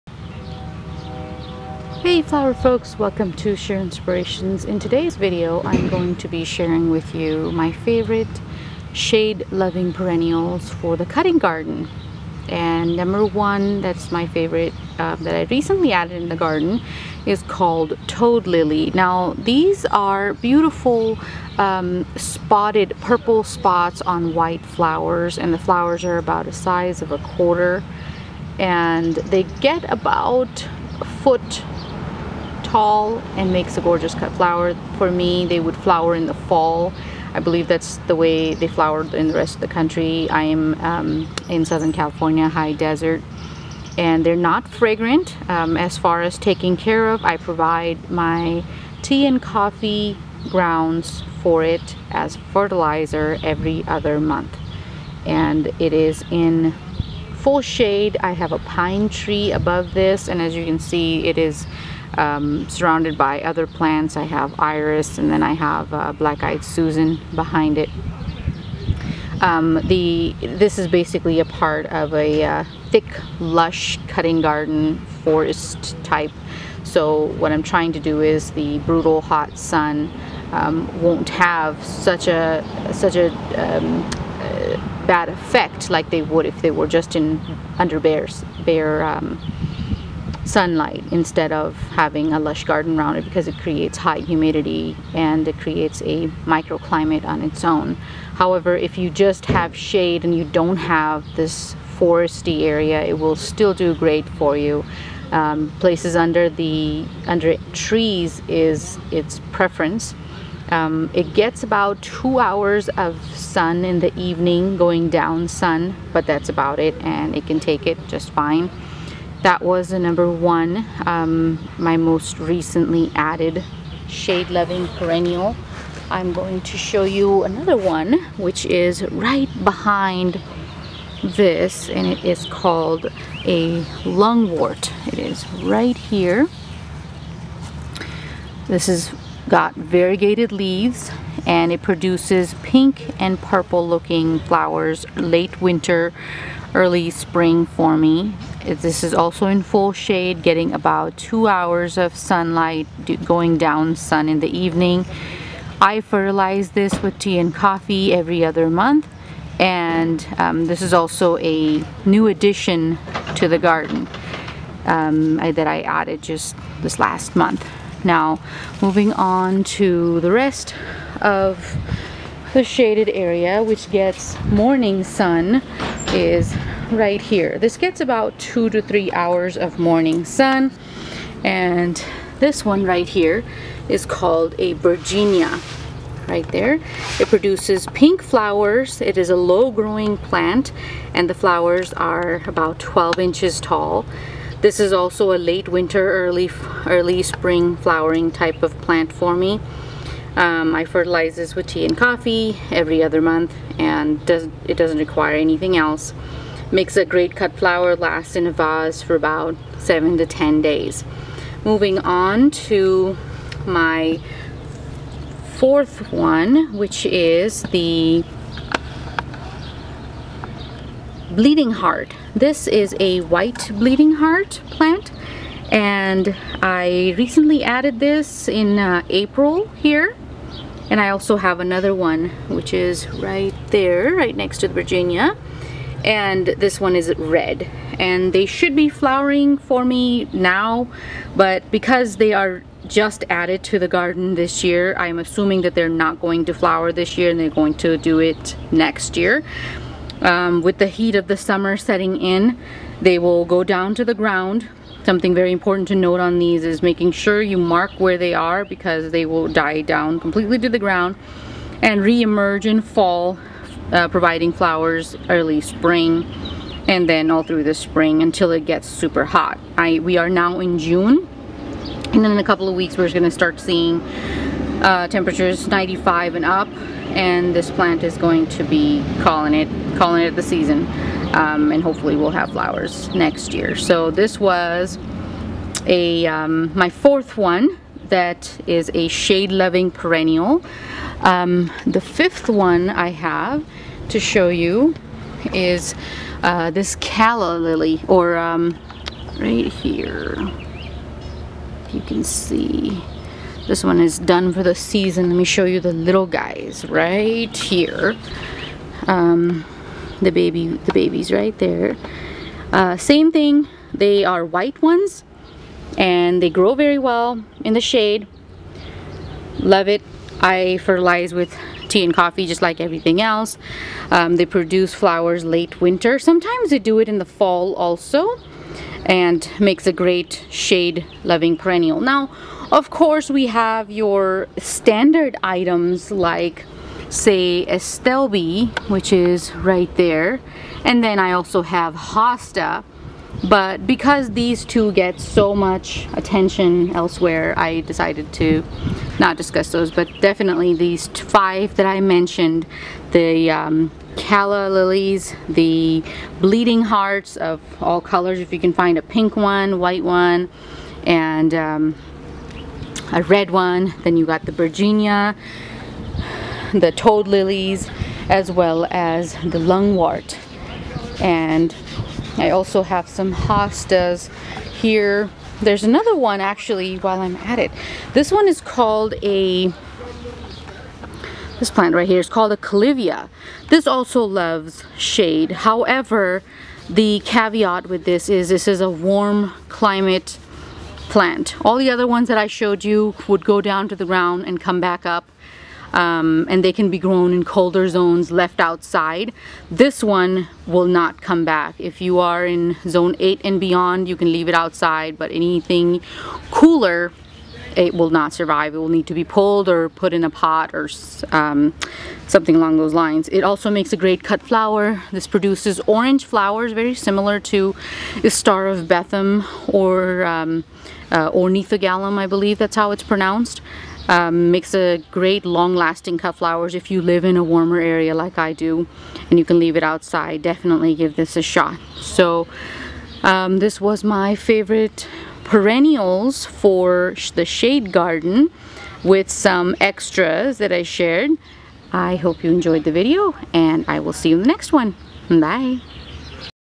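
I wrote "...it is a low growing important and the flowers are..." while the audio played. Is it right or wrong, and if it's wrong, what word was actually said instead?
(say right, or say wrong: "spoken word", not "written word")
wrong: "plant", not "important".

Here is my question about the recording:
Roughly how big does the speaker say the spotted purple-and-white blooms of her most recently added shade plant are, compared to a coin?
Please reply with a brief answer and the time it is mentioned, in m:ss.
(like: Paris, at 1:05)
size of a quarter, at 0:26.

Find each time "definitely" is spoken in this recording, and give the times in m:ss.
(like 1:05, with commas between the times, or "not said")
5:50, 7:10.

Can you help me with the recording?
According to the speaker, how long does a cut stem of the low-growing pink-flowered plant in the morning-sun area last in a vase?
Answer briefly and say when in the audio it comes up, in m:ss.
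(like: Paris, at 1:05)
7 to 10 days, at 3:29.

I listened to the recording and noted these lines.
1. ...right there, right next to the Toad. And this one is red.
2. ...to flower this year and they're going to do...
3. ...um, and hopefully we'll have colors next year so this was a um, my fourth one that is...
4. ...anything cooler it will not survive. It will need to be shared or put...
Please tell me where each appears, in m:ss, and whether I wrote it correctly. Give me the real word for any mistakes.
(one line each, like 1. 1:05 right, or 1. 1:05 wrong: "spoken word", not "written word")
1. 3:53 wrong: "Bergenia", not "Toad"
2. 4:06 right
3. 4:41 wrong: "flowers", not "colors"
4. 6:45 wrong: "pulled", not "shared".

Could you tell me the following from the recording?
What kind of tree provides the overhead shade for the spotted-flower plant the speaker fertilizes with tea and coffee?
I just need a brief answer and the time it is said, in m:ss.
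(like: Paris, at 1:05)
pine tree, at 0:58.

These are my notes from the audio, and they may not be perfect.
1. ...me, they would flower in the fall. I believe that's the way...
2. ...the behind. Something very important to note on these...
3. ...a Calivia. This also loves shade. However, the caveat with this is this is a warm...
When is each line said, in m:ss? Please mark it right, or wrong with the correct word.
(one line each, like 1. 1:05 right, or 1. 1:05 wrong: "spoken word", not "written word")
1. 0:35 right
2. 4:14 wrong: "ground", not "behind"
3. 6:22 right.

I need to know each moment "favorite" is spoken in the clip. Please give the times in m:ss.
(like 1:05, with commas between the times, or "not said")
0:07, 0:14, 7:14.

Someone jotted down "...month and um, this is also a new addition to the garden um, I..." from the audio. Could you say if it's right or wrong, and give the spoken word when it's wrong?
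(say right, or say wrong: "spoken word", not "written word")
right.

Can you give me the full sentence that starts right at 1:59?
That was the number one, um, my most recently added shade loving perennial.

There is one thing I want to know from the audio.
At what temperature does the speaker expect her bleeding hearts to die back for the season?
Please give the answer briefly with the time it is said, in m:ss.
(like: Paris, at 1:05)
95, at 4:35.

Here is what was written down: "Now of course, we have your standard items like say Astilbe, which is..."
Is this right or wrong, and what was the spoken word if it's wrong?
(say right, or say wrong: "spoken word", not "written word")
right.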